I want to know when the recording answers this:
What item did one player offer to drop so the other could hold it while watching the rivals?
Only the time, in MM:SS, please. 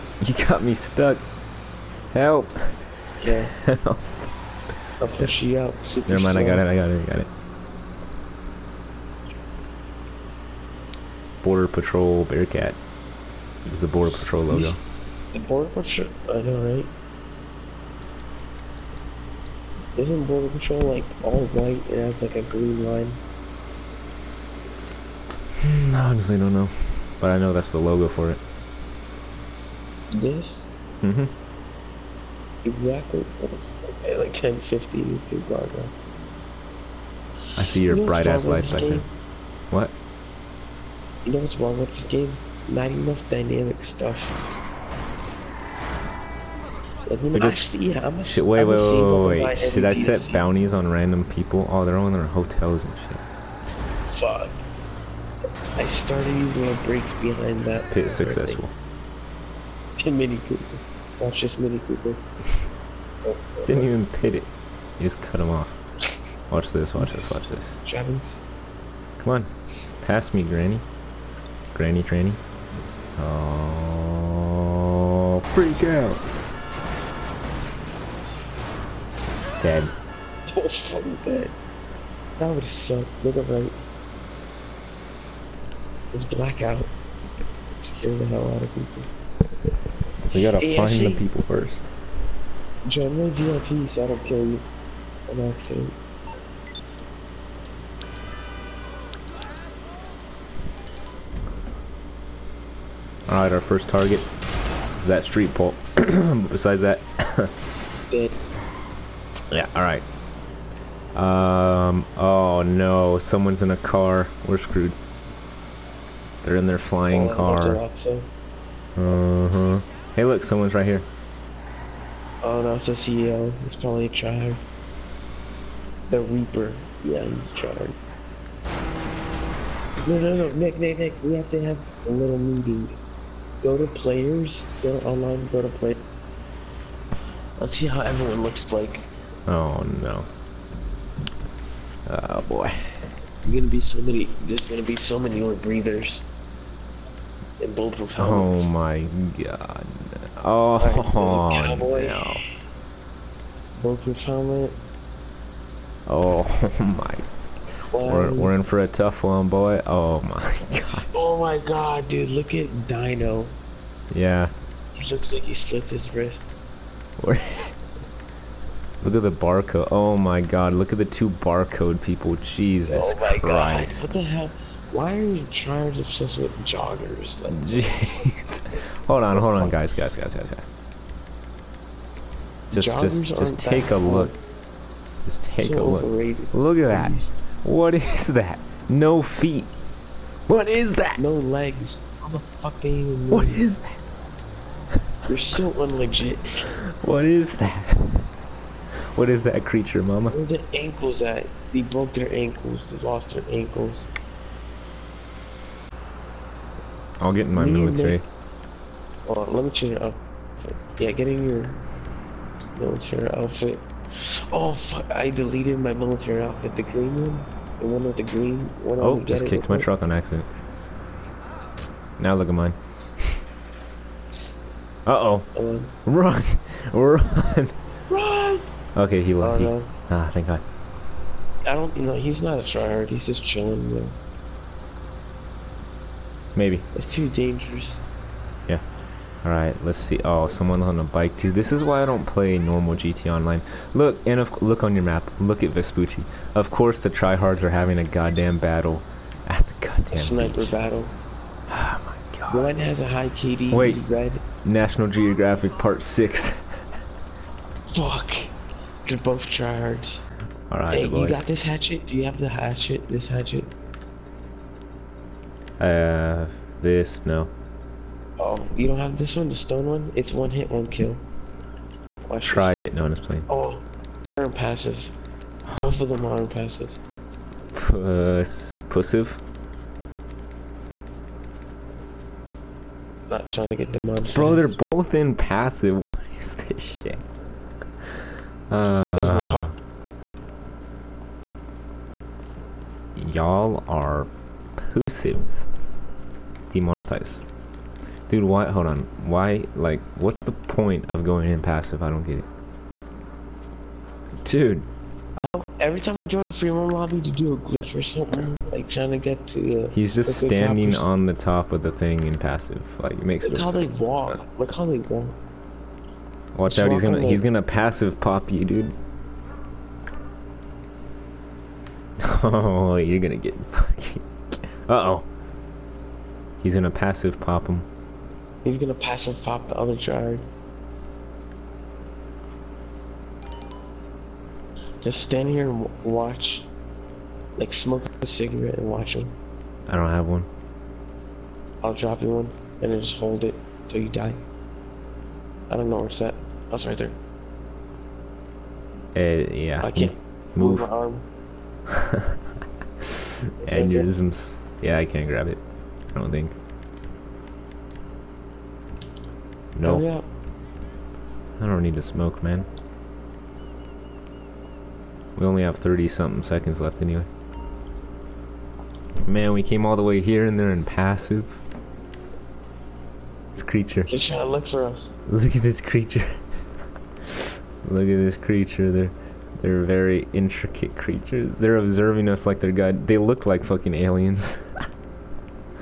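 05:38.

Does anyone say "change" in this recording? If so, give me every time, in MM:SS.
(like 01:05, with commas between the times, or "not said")
03:29.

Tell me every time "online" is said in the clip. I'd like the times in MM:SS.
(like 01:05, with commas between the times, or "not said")
02:15, 04:03.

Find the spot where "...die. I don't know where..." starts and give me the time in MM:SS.
05:44.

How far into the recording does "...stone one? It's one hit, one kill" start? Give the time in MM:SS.
04:29.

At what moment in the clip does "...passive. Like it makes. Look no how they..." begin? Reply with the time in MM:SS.
05:12.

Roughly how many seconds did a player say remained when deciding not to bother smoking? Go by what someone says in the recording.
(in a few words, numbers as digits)
30.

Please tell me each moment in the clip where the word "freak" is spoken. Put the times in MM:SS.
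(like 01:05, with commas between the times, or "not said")
01:15.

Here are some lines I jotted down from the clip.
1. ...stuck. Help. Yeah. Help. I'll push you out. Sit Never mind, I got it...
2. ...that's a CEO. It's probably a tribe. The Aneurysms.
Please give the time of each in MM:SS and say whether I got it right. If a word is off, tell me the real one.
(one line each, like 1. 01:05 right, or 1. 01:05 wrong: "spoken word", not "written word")
1. 00:00 right
2. 02:02 wrong: "Reaper", not "Aneurysms".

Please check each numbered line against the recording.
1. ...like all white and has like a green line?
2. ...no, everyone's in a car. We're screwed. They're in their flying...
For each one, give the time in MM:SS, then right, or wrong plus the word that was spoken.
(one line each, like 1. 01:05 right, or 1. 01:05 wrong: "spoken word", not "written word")
1. 00:20 right
2. 01:52 wrong: "someone", not "everyone".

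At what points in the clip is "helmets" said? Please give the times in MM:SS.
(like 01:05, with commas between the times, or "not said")
02:28, 02:34.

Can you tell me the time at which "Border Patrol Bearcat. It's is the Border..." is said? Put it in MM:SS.
00:11.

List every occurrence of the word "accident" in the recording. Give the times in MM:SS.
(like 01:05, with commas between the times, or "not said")
01:35, 03:40.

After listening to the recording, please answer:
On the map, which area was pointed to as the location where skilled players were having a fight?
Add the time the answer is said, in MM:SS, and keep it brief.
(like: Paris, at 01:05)
Vespucci, at 04:05.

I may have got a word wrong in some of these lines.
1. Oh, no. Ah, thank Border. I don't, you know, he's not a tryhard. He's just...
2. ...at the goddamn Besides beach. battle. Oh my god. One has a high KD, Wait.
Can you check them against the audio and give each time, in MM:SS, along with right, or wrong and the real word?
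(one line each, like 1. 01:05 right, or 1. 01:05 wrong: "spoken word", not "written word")
1. 03:49 wrong: "God", not "Border"
2. 04:09 wrong: "Sniper", not "Besides".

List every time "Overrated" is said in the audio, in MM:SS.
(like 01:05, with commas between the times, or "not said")
03:06.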